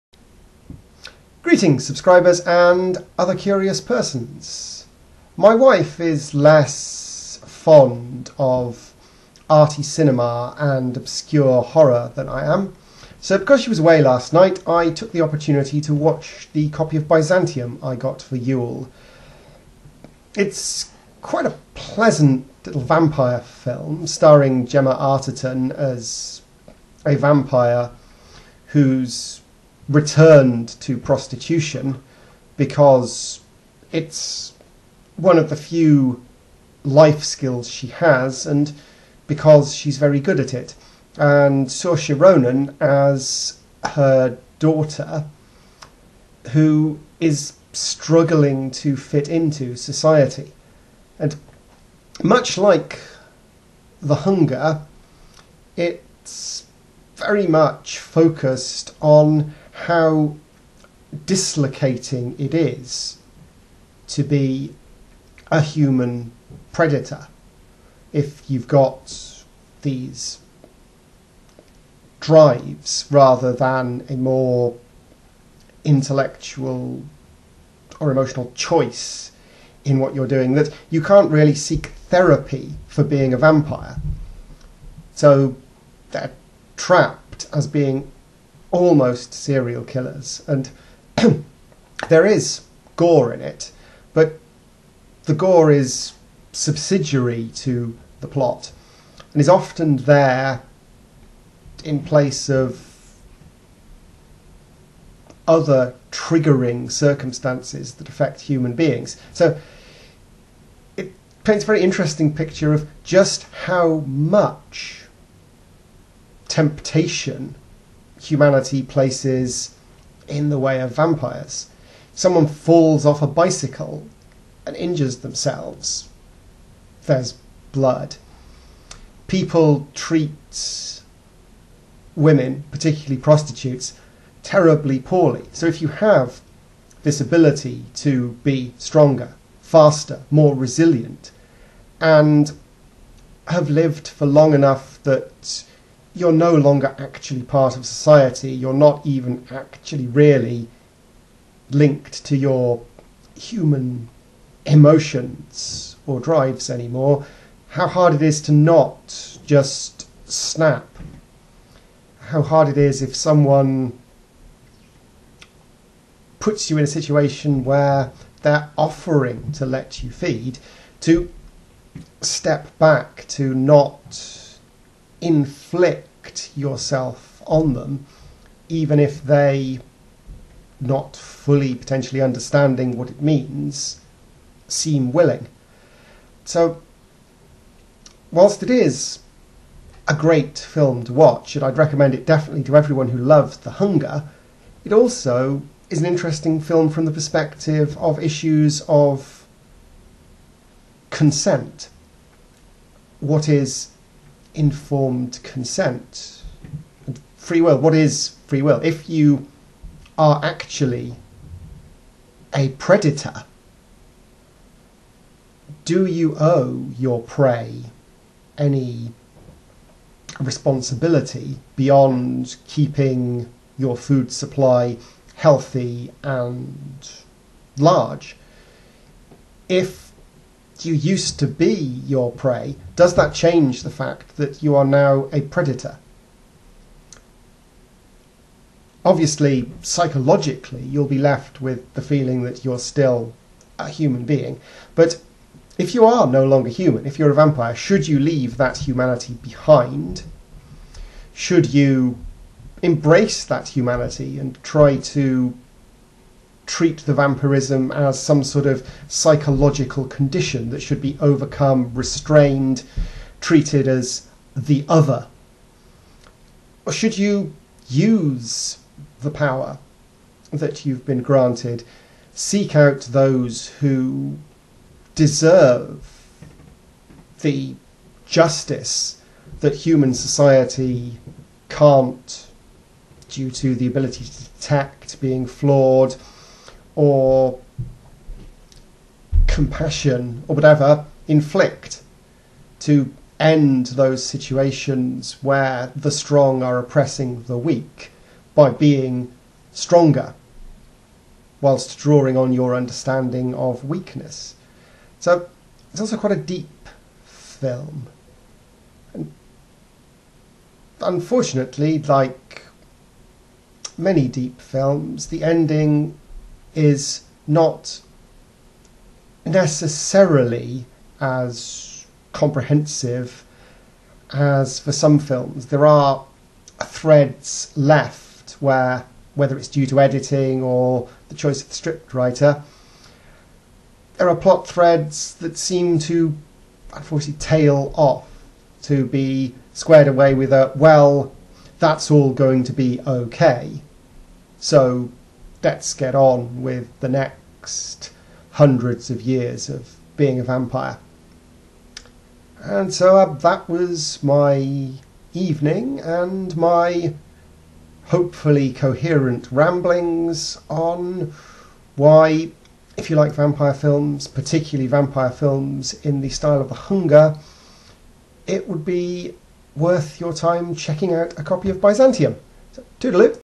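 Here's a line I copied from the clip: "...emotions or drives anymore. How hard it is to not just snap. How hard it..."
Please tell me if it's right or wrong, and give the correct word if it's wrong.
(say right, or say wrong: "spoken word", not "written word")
right.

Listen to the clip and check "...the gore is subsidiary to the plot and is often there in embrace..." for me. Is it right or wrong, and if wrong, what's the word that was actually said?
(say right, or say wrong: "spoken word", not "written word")
wrong: "place", not "embrace".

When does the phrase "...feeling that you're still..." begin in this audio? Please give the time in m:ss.
4:02.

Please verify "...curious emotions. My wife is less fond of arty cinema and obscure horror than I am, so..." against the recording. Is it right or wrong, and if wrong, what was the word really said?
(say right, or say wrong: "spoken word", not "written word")
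wrong: "persons", not "emotions".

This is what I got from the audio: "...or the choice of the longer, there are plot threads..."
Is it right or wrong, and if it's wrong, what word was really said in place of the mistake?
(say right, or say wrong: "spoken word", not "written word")
wrong: "scriptwriter", not "longer".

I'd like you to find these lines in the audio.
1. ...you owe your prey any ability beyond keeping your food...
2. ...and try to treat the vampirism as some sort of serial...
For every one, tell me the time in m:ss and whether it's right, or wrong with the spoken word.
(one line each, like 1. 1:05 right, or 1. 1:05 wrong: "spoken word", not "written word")
1. 3:36 wrong: "responsibility", not "ability"
2. 4:14 wrong: "psychological", not "serial".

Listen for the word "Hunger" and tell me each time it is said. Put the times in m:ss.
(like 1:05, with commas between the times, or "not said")
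0:54, 3:13, 6:06.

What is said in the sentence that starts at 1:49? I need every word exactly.
So it paints a very interesting picture of just how much temptation humanity places in the way of vampires.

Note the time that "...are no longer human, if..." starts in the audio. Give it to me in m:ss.
4:06.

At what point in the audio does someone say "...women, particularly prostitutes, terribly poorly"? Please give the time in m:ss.
2:12.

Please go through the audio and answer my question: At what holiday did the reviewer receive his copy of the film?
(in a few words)
Yule.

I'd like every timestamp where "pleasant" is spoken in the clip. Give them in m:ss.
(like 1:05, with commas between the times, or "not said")
0:21.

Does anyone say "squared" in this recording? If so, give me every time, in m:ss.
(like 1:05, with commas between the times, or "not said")
5:39.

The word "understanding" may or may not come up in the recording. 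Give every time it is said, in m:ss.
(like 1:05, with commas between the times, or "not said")
3:02, 5:02.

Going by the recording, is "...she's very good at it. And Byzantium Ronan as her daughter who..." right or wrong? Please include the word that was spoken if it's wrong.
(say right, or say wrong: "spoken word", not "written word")
wrong: "Saoirse", not "Byzantium".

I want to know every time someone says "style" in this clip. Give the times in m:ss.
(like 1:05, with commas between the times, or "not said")
6:06.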